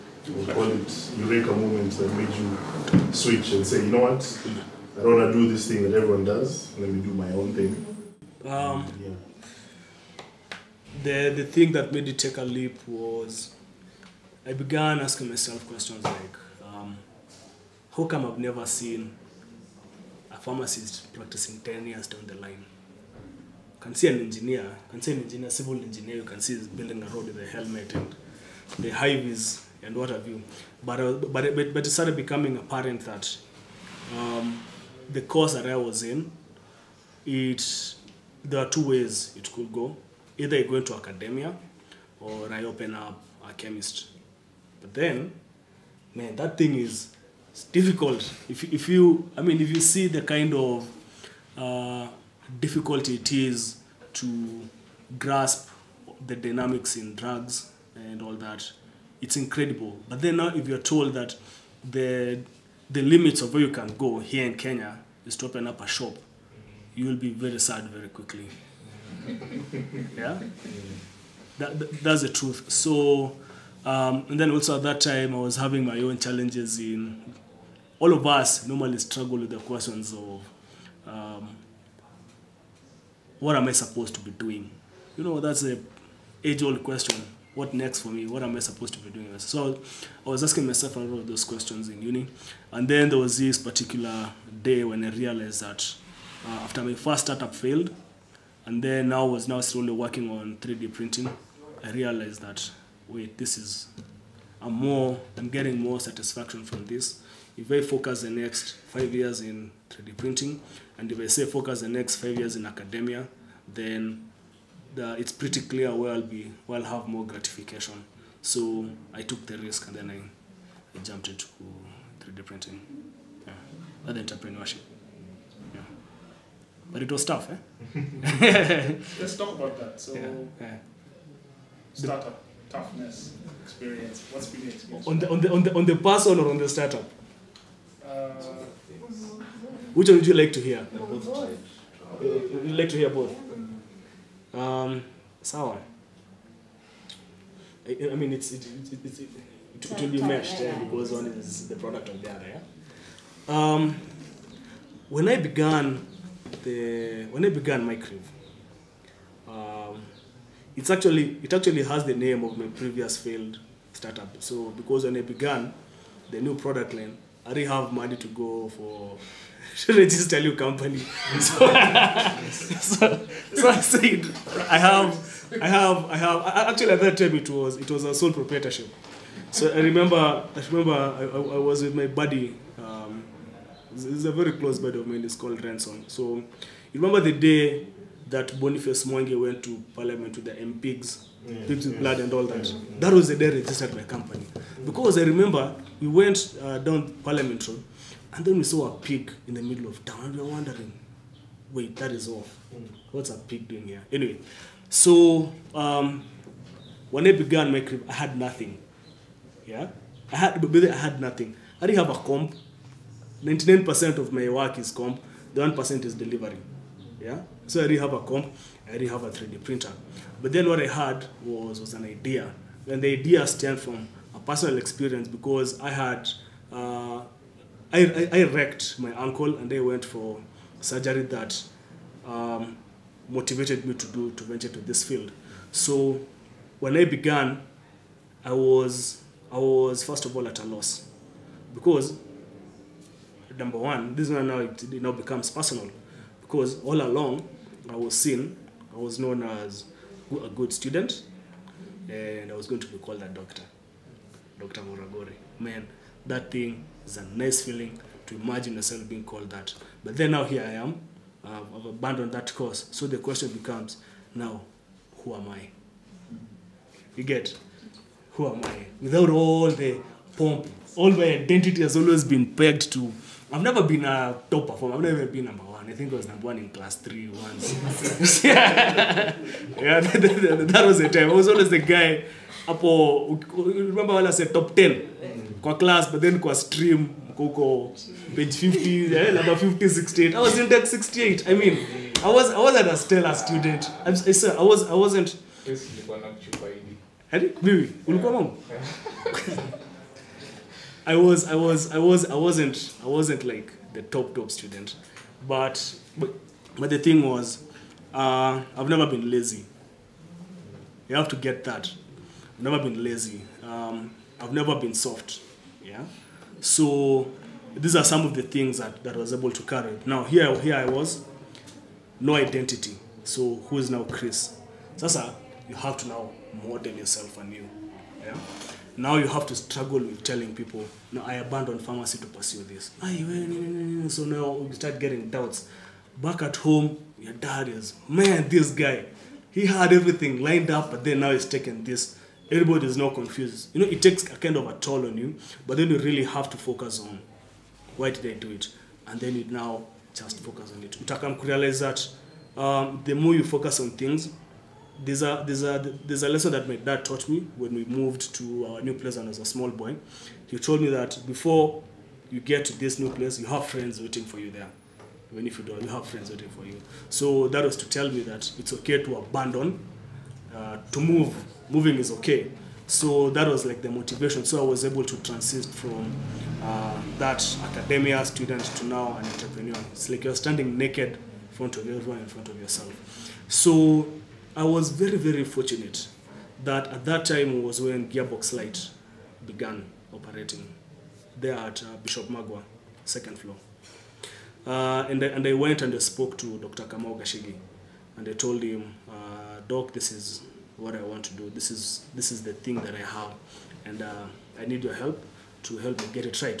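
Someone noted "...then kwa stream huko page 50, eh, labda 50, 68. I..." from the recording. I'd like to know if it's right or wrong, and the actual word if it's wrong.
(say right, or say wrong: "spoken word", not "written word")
right.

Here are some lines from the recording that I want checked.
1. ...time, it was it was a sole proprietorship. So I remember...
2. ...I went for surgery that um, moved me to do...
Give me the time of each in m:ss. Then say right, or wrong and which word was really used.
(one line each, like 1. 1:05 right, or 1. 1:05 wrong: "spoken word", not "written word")
1. 2:57 right
2. 3:49 wrong: "motivated", not "moved".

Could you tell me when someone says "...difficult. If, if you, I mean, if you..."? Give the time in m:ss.
0:47.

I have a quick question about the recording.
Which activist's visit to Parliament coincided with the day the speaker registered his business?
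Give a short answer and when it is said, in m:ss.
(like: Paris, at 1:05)
Boniface Mwangi, at 3:08.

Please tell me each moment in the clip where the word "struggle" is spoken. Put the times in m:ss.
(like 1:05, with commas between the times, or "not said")
1:18, 5:29.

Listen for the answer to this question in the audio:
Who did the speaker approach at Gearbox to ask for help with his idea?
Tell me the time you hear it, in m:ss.
6:36.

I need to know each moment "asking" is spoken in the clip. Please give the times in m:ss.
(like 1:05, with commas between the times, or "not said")
0:14, 1:30.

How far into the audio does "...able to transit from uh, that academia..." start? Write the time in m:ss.
6:14.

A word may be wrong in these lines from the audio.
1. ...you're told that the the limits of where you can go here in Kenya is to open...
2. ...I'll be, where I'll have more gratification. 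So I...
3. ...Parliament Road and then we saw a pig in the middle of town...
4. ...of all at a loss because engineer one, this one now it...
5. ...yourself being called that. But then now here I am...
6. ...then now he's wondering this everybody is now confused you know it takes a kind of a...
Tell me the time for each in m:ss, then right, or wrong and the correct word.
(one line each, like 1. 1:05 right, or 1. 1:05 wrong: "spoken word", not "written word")
1. 1:00 right
2. 1:56 right
3. 3:17 right
4. 4:00 wrong: "number", not "engineer"
5. 4:18 right
6. 5:41 wrong: "taking", not "wondering".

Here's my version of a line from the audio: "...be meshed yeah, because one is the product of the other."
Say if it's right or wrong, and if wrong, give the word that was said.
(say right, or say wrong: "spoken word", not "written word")
right.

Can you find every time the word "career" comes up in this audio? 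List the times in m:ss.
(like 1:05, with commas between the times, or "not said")
2:37, 3:27.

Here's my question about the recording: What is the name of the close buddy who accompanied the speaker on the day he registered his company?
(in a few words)
Ransom.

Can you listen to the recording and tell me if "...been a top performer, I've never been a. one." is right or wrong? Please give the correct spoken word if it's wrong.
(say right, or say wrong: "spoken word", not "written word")
right.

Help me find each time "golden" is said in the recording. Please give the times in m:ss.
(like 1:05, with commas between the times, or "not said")
not said.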